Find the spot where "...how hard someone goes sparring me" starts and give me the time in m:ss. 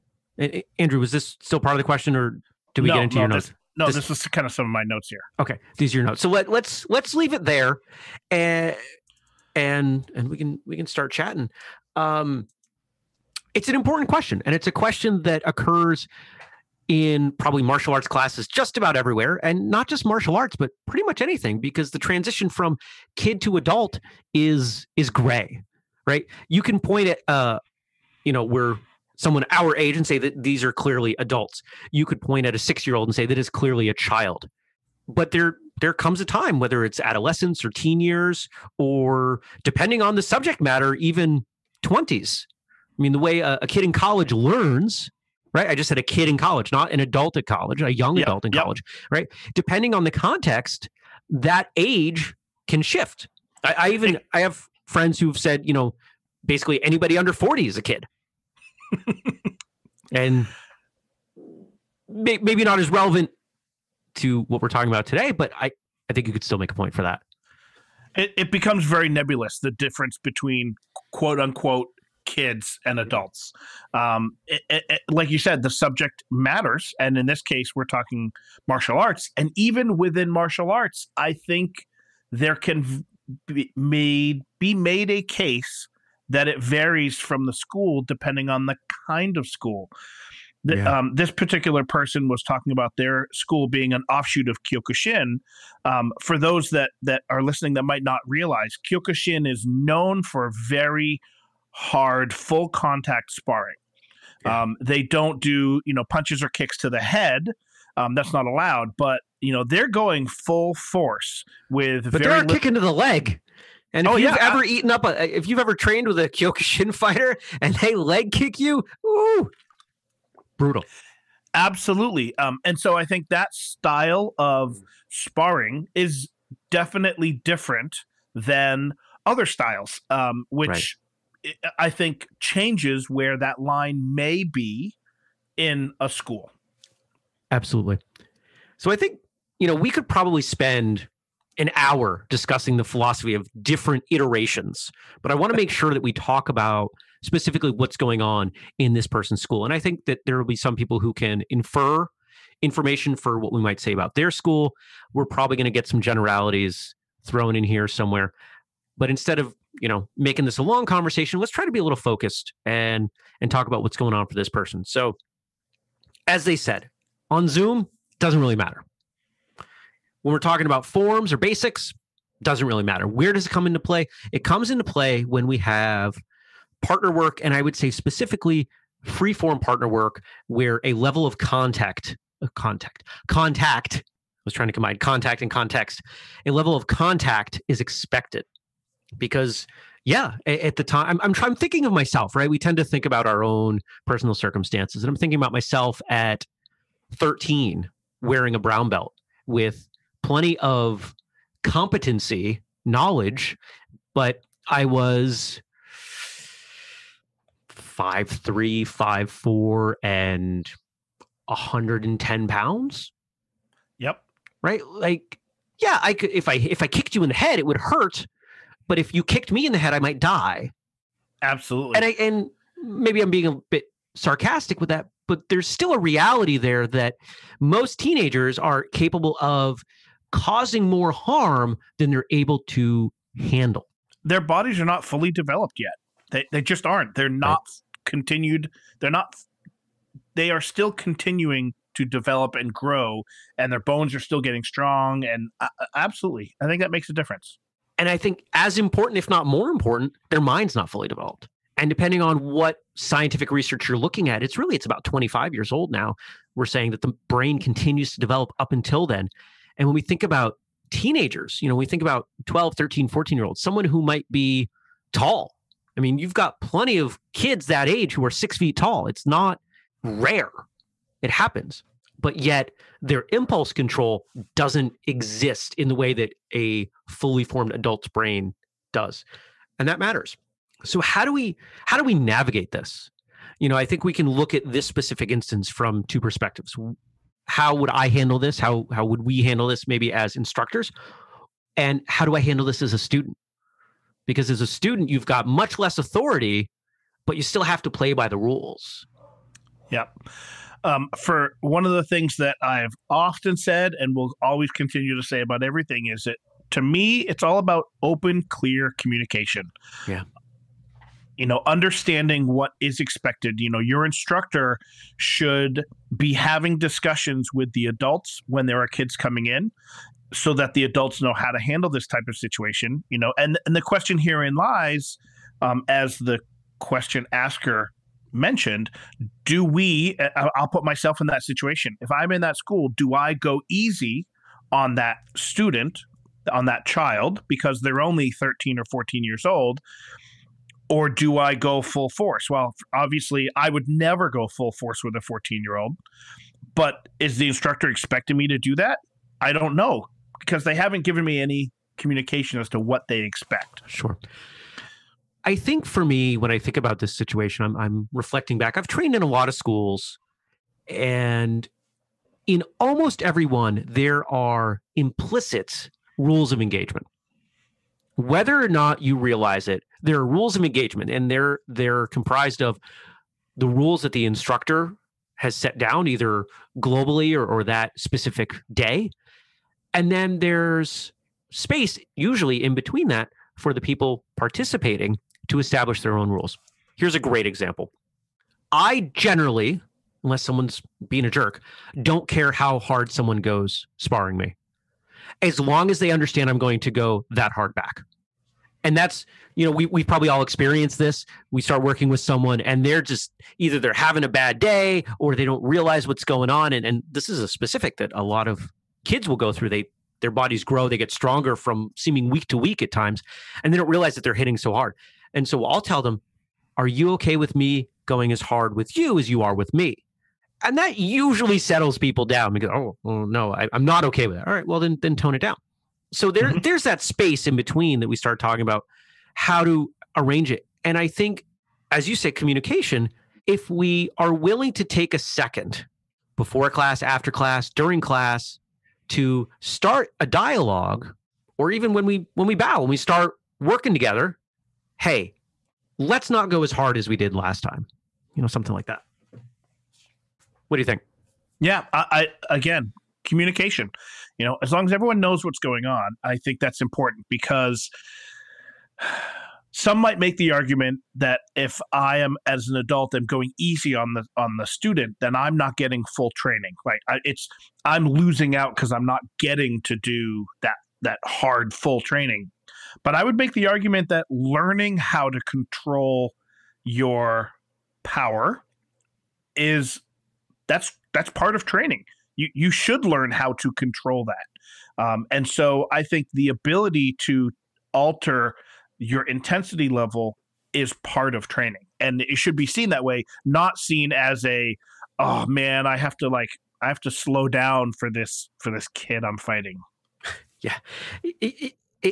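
6:32.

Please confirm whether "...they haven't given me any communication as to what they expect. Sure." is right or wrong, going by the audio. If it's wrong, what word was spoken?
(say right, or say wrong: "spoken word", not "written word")
right.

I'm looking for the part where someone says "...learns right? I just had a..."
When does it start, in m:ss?
0:44.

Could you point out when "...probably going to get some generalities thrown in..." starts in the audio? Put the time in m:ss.
2:35.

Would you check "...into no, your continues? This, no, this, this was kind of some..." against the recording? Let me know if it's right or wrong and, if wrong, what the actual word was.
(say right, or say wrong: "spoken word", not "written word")
wrong: "notes", not "continues".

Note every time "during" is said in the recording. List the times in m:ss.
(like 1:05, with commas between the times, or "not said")
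7:17.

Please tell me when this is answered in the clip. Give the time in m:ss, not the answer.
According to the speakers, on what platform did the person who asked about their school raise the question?
2:47.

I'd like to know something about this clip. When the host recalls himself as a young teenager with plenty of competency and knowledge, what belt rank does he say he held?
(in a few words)
Brown belt.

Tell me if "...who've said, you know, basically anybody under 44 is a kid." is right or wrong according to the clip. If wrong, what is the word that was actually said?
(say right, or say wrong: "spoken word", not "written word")
wrong: "40", not "44".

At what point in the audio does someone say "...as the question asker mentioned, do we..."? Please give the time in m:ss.
5:25.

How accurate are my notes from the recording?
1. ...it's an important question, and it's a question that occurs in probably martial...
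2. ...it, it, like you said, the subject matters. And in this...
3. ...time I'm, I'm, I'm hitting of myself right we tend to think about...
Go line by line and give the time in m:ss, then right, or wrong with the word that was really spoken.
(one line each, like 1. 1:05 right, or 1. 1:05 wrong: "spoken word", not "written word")
1. 0:13 right
2. 1:14 right
3. 3:10 wrong: "thinking", not "hitting".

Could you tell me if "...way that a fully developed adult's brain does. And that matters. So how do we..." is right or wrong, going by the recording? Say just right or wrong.
wrong.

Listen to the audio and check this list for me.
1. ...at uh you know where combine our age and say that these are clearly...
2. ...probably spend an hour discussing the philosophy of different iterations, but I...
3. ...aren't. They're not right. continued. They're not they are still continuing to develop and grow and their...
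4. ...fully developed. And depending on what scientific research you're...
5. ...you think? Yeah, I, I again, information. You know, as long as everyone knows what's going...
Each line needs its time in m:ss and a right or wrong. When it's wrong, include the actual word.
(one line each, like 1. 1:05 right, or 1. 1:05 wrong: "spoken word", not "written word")
1. 0:27 wrong: "someone", not "combine"
2. 2:20 right
3. 3:56 right
4. 4:10 right
5. 7:30 wrong: "communication", not "information".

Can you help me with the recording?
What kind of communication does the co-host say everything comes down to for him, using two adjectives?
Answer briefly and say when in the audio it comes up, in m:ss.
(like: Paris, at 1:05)
Open, clear communication, at 5:08.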